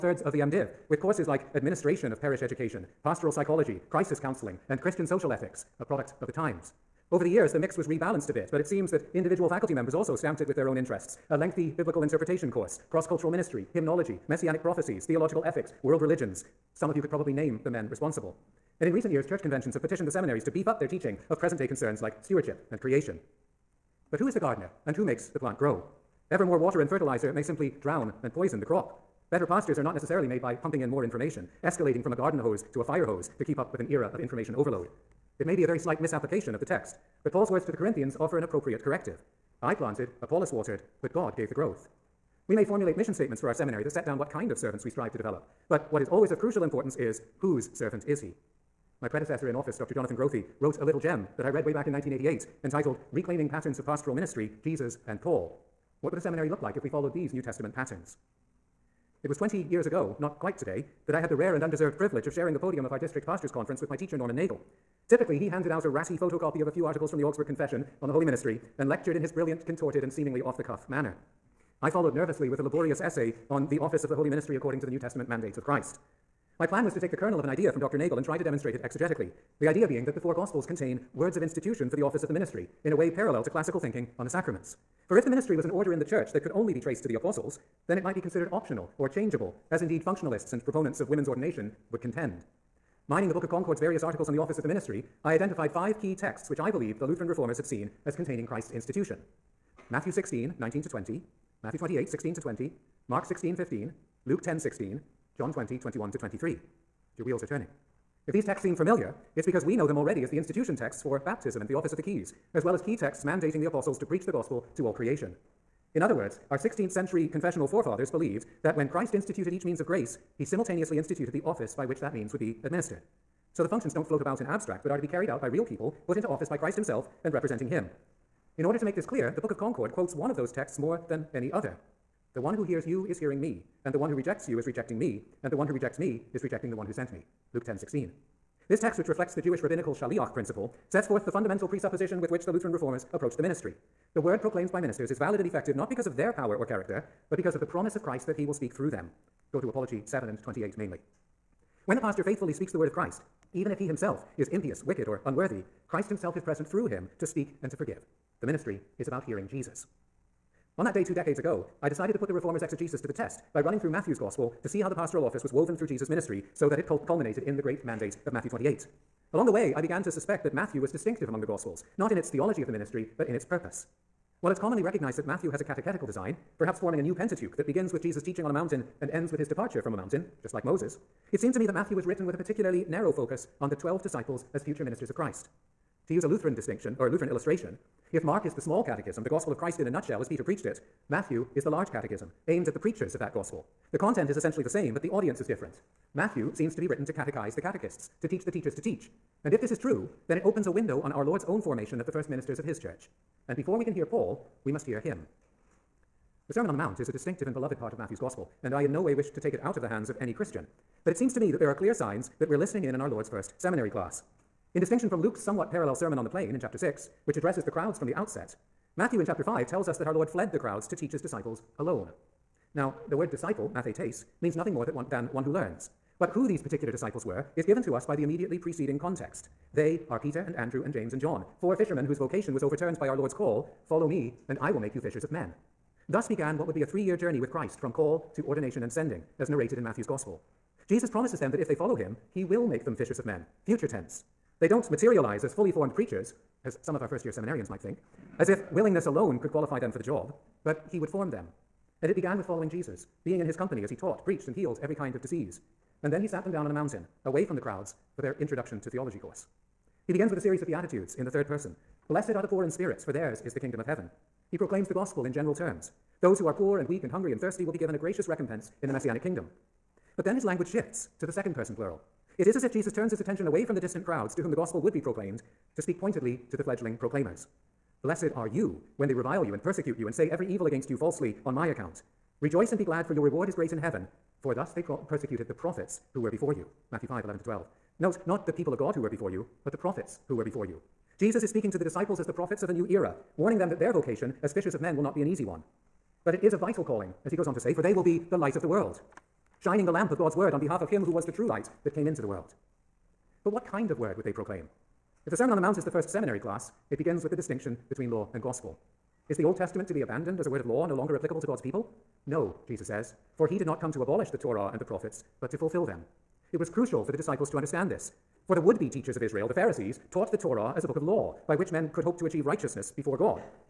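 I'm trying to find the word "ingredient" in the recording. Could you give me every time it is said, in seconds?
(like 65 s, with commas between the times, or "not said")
not said.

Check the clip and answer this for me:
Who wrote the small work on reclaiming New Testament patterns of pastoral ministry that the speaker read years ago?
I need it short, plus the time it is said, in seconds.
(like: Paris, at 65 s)
Jonathan Grothe, at 49 s.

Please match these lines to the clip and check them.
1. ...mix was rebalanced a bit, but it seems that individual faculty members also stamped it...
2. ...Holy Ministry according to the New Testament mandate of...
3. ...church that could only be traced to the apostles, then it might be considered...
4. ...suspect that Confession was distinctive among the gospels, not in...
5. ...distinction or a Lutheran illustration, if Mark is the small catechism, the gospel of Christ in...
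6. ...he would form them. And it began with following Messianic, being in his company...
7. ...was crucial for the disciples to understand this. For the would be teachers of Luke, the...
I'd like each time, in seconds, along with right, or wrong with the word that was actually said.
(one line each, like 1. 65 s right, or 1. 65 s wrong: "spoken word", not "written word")
1. 7 s right
2. 74 s right
3. 86 s right
4. 170 s wrong: "Matthew", not "Confession"
5. 186 s right
6. 250 s wrong: "Jesus", not "Messianic"
7. 316 s wrong: "Israel", not "Luke".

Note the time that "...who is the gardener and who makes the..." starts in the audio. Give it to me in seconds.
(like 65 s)
24 s.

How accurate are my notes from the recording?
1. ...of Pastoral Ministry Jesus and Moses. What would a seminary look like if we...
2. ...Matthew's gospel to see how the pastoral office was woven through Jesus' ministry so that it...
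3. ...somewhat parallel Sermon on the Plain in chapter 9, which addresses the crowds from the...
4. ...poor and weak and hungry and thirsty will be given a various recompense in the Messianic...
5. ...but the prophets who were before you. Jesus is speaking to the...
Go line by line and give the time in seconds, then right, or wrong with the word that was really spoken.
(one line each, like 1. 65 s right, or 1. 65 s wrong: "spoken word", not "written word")
1. 53 s wrong: "Paul", not "Moses"
2. 163 s right
3. 215 s wrong: "6", not "9"
4. 266 s wrong: "gracious", not "various"
5. 289 s right.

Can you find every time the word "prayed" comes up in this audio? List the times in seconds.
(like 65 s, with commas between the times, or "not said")
not said.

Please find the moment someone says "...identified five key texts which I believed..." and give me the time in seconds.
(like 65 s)
95 s.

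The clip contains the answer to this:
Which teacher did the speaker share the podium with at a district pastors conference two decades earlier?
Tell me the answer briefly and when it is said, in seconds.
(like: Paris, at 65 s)
Norman Nagel, at 64 s.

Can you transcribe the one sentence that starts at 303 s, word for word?
But what kind of word would they proclaim?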